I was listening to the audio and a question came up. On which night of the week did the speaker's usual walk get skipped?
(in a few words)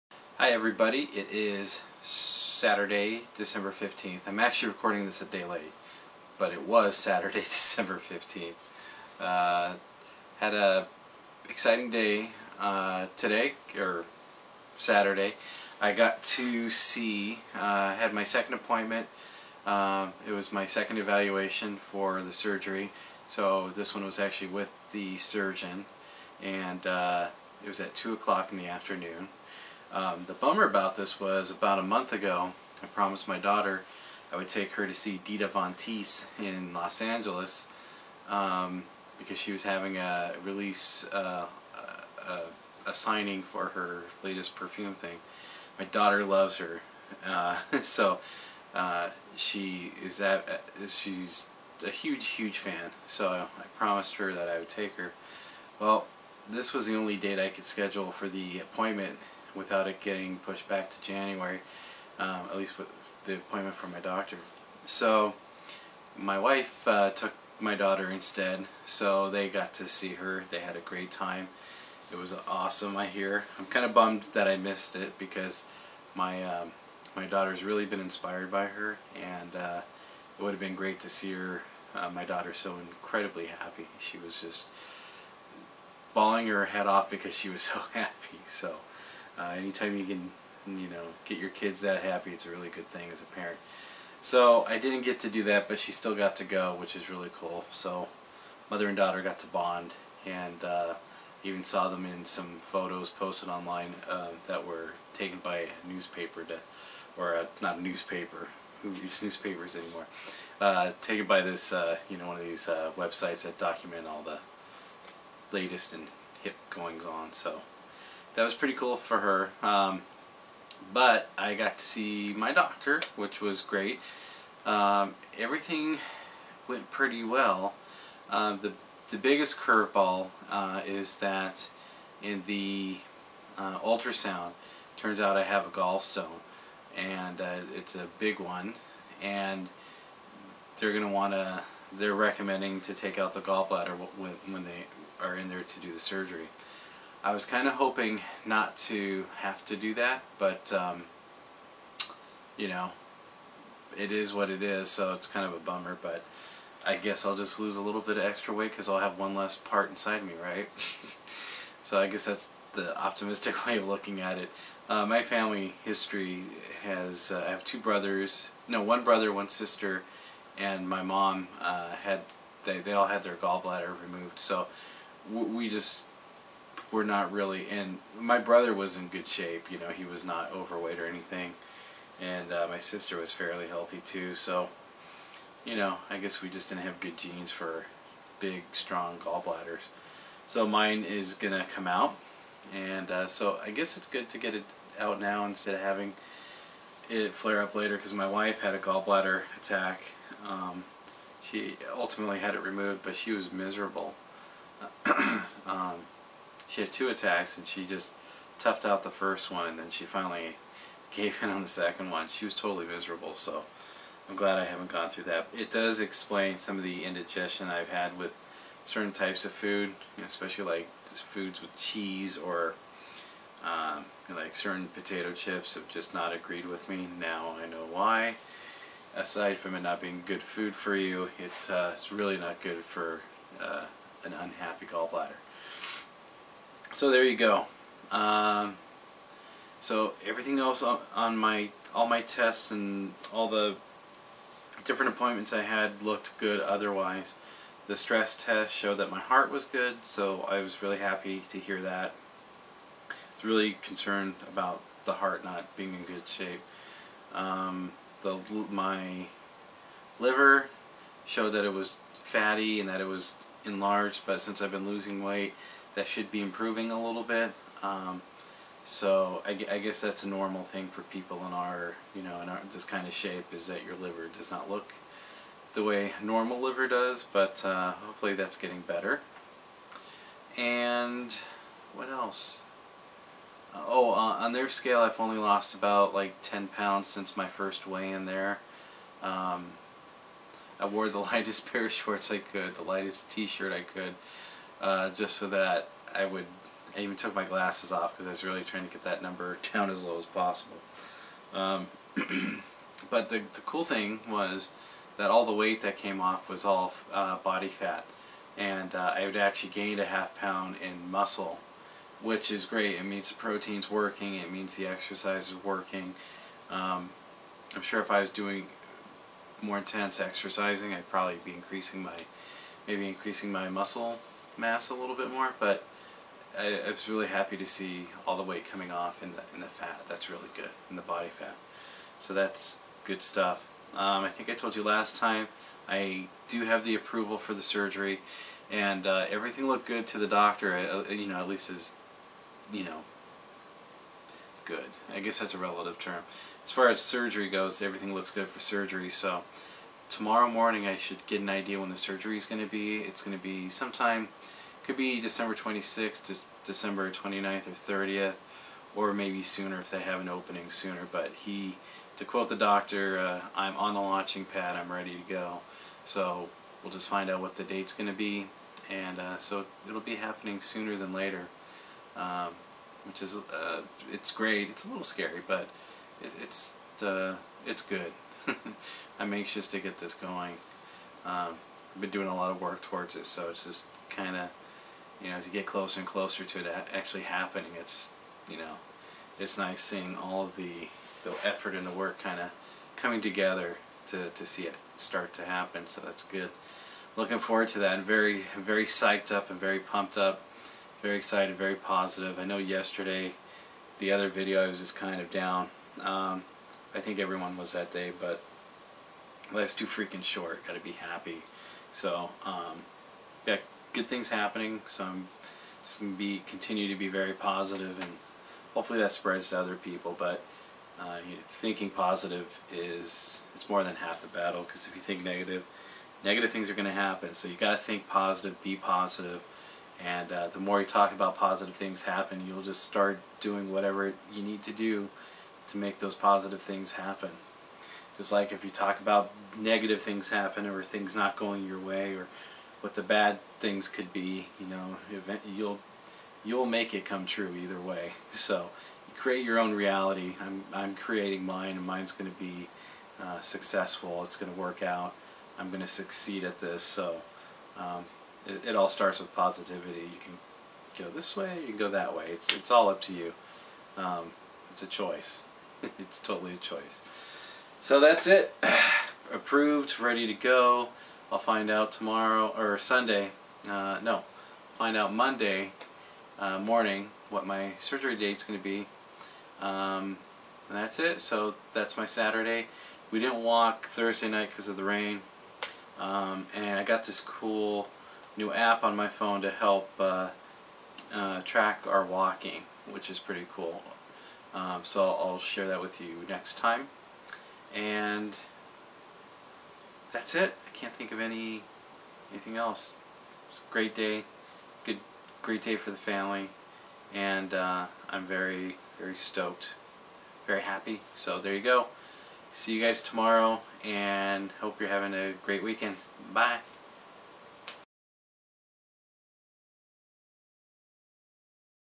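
Thursday.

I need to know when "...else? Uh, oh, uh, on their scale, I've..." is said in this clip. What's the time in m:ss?
4:42.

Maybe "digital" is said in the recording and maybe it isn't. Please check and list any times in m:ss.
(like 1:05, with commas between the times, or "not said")
not said.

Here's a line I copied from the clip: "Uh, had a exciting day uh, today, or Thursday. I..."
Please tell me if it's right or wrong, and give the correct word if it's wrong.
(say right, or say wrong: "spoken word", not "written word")
wrong: "Saturday", not "Thursday".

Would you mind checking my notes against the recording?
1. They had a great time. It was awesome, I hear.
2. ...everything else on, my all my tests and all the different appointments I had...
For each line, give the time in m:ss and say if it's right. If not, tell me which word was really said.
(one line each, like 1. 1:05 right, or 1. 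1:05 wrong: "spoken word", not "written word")
1. 1:10 right
2. 4:00 right.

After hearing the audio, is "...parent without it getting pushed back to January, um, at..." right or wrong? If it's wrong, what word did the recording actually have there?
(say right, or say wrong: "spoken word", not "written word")
wrong: "appointment", not "parent".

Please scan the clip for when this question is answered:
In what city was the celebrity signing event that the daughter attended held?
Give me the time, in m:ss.
0:36.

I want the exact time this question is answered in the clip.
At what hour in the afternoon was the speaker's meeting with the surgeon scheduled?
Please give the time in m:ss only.
0:27.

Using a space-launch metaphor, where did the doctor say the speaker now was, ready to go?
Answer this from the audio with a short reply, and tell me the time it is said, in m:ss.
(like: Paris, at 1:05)
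The launching pad, at 6:04.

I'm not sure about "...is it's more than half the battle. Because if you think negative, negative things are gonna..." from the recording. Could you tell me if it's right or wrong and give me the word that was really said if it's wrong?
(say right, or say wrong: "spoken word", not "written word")
right.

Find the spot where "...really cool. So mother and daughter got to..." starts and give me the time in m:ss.
1:37.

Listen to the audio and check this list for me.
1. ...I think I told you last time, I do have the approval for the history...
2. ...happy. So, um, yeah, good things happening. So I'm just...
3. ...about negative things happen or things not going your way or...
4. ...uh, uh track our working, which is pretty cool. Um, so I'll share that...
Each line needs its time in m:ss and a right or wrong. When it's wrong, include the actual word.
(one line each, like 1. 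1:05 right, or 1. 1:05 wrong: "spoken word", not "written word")
1. 5:34 wrong: "surgery", not "history"
2. 6:50 right
3. 7:18 right
4. 8:09 wrong: "walking", not "working".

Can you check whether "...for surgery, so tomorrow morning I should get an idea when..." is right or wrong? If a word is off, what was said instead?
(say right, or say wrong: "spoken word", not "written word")
right.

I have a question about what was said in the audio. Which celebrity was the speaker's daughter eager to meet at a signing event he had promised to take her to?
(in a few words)
Dita Von Teese.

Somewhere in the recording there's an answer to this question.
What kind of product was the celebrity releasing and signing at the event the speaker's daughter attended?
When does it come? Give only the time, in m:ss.
0:44.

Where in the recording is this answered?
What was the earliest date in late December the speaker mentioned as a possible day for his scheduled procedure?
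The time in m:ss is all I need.
5:55.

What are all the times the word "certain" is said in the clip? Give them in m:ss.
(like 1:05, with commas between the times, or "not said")
3:38, 3:44.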